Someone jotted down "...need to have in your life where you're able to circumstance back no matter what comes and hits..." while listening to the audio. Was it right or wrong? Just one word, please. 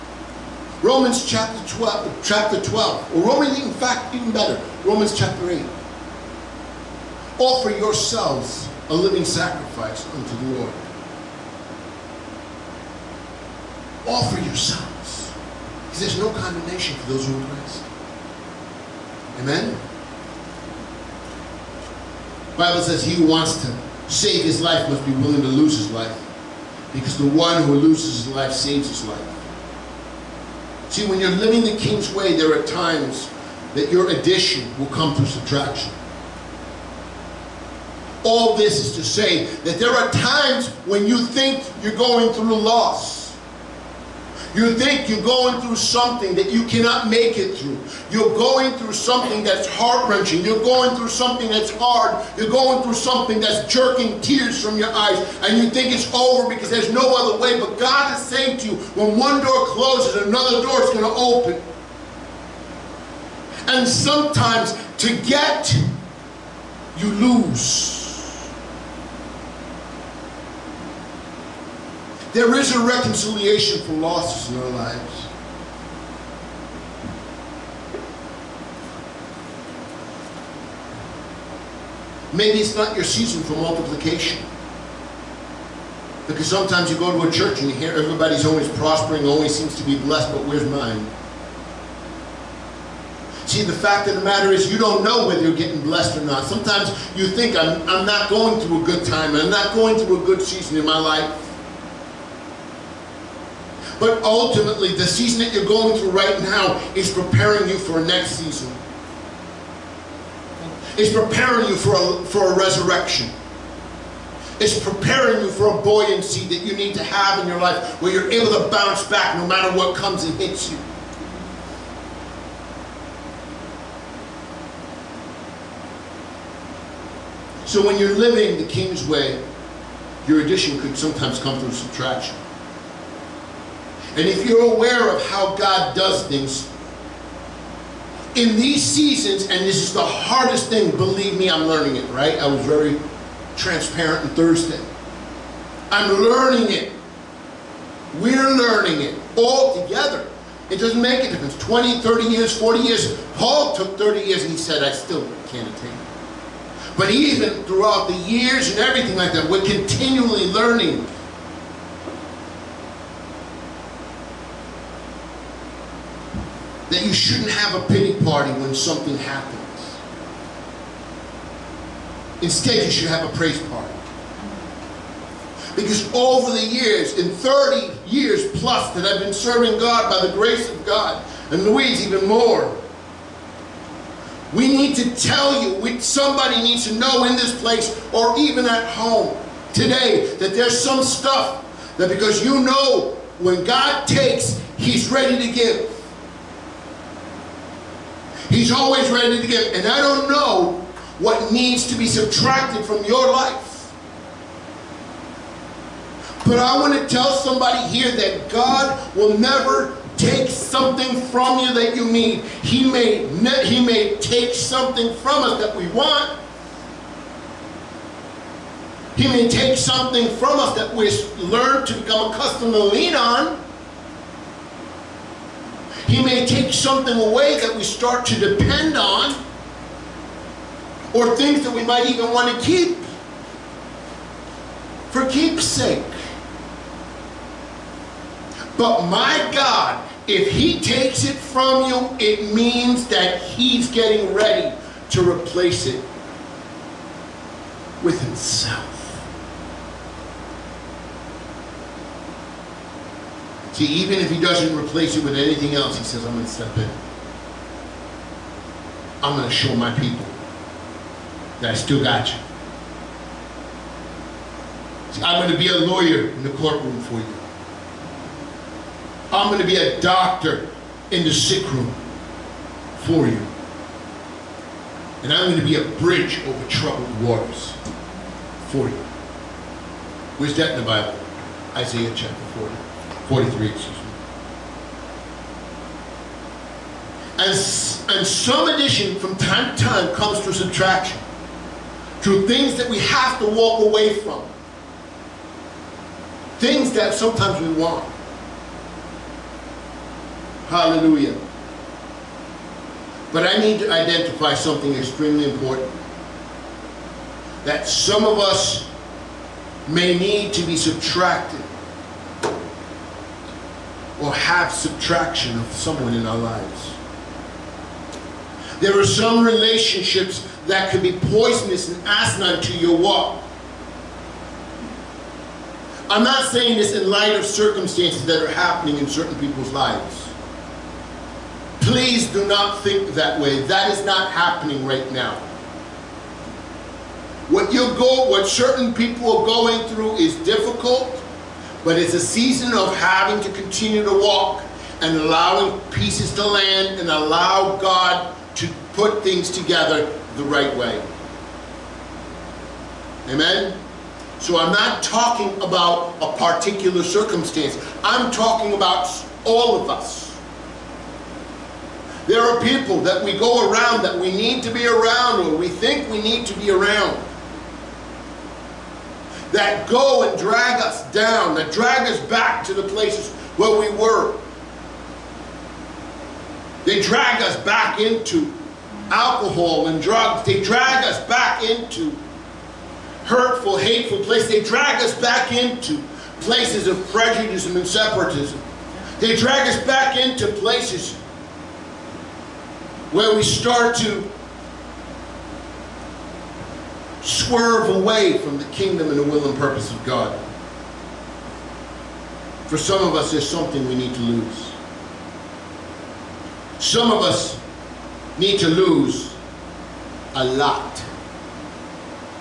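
wrong.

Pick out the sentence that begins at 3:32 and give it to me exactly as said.
He may, he may take something from us that we want.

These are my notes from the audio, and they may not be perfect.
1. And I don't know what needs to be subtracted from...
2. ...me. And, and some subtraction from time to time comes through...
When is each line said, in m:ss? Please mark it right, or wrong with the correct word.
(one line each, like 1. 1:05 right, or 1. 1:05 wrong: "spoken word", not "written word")
1. 3:19 right
2. 4:43 wrong: "addition", not "subtraction".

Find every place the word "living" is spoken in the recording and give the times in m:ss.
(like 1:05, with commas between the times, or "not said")
0:08, 0:31, 2:08.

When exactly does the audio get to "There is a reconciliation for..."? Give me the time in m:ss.
1:12.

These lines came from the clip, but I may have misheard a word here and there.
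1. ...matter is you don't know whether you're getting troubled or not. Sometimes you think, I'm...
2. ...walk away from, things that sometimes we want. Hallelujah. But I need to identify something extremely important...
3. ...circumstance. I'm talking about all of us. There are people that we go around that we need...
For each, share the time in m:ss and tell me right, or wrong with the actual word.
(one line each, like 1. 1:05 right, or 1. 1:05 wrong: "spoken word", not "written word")
1. 1:34 wrong: "blessed", not "troubled"
2. 4:53 right
3. 5:57 right.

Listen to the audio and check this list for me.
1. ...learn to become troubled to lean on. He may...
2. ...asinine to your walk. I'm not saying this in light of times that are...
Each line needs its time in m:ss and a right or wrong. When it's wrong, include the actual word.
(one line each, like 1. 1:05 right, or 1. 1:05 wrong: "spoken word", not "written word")
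1. 3:41 wrong: "accustomed", not "troubled"
2. 5:22 wrong: "circumstances", not "times".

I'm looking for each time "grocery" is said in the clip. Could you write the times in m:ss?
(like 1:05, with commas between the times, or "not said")
not said.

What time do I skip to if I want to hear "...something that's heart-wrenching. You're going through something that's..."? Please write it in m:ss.
0:48.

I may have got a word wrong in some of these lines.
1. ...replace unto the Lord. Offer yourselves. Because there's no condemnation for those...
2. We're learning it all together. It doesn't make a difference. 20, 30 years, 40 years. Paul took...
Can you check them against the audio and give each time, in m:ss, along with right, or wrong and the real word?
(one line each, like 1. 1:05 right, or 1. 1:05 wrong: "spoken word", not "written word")
1. 0:09 wrong: "sacrifice", not "replace"
2. 2:28 right.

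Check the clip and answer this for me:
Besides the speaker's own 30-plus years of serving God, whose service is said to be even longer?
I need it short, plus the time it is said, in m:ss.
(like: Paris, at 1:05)
Louise, at 3:01.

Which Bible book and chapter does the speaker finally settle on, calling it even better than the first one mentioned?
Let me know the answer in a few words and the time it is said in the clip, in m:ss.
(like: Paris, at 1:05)
Romans 8, at 0:04.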